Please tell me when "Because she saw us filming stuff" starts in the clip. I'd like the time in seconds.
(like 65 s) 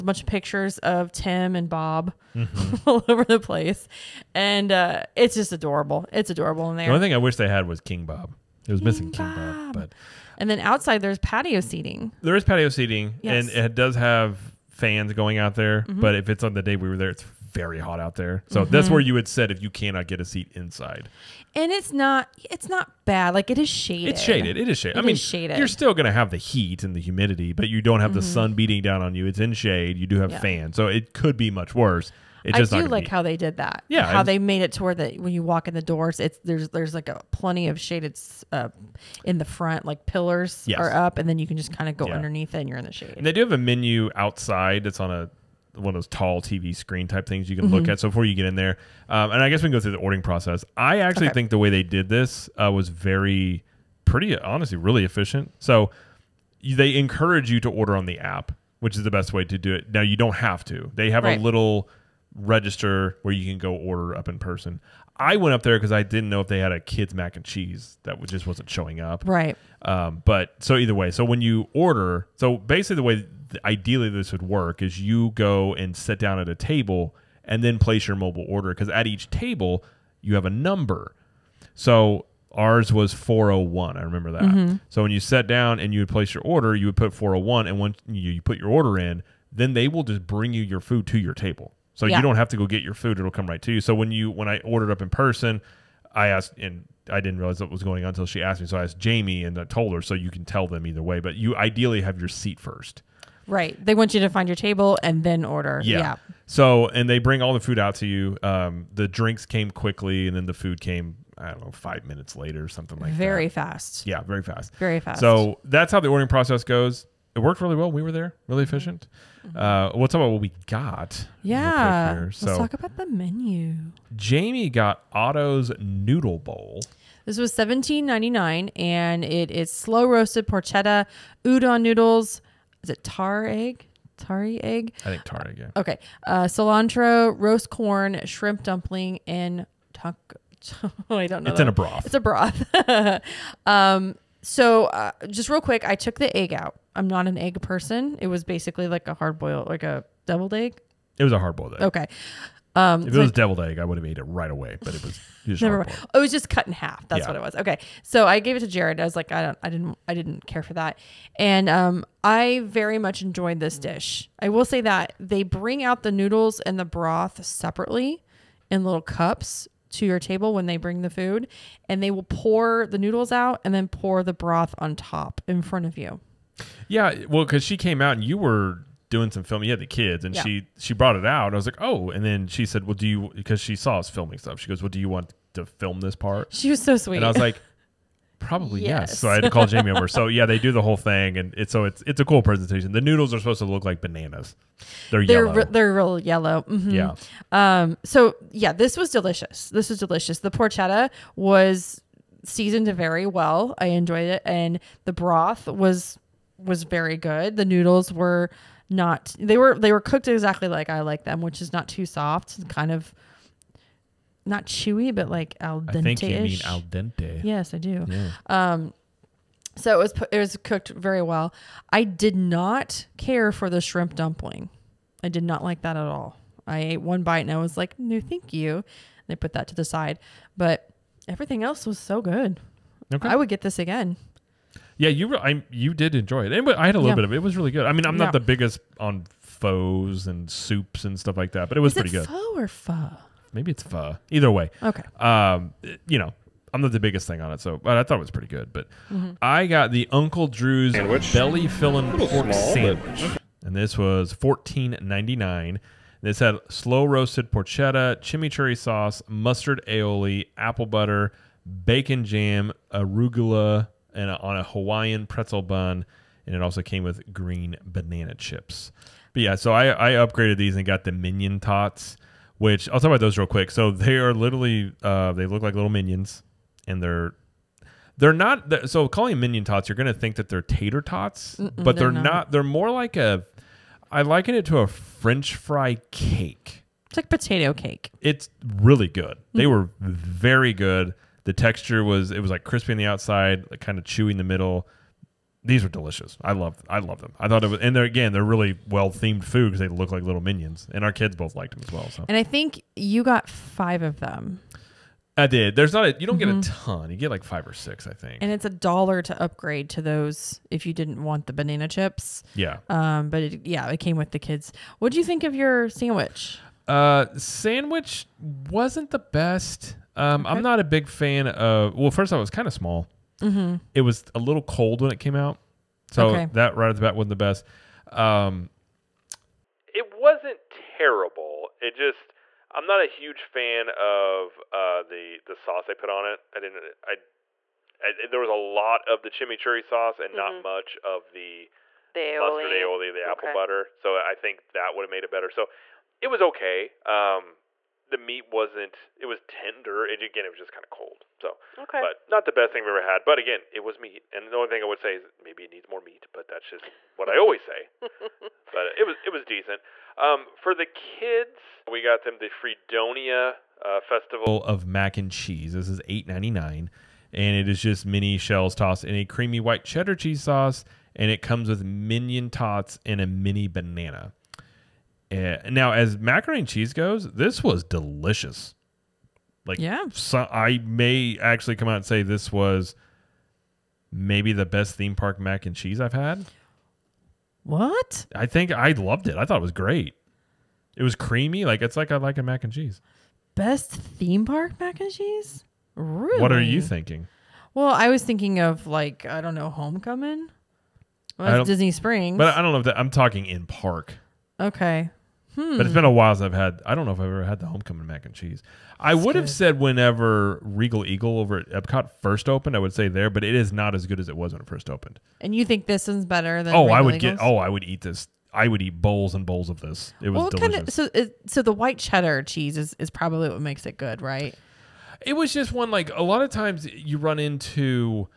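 183 s.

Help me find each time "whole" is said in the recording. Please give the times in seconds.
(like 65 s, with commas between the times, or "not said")
190 s.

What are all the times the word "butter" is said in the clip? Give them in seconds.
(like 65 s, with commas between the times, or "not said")
260 s, 343 s.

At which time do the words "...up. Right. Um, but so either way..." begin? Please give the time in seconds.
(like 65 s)
68 s.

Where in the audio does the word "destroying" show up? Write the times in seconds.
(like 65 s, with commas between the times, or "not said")
not said.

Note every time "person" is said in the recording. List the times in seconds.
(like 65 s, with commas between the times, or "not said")
64 s, 95 s, 147 s.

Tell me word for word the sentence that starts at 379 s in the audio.
Like, yeah, so I may actually come out and say this was maybe the best theme park mac and cheese I've had.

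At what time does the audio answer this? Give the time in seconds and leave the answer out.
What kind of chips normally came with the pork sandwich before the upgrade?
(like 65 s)
267 s.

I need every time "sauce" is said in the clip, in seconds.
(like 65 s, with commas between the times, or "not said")
258 s, 335 s, 339 s, 370 s.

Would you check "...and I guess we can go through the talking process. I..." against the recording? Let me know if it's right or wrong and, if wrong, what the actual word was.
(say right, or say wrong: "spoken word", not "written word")
wrong: "ordering", not "talking".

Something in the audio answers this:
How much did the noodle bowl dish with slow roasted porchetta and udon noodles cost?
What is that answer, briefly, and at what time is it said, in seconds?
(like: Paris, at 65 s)
$17.99, at 127 s.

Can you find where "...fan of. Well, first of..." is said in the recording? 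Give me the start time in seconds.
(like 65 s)
321 s.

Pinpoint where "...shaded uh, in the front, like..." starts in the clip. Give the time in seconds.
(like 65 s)
37 s.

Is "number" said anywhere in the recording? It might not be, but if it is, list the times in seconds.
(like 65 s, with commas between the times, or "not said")
80 s.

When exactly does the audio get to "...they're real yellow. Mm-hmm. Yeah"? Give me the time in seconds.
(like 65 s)
195 s.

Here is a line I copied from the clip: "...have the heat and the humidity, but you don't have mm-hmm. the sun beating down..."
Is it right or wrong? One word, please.
right.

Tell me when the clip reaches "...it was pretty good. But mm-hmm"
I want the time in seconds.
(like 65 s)
248 s.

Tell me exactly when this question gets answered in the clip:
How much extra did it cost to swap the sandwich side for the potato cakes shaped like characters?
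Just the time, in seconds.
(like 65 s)
308 s.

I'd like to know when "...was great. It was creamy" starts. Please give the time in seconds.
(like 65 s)
389 s.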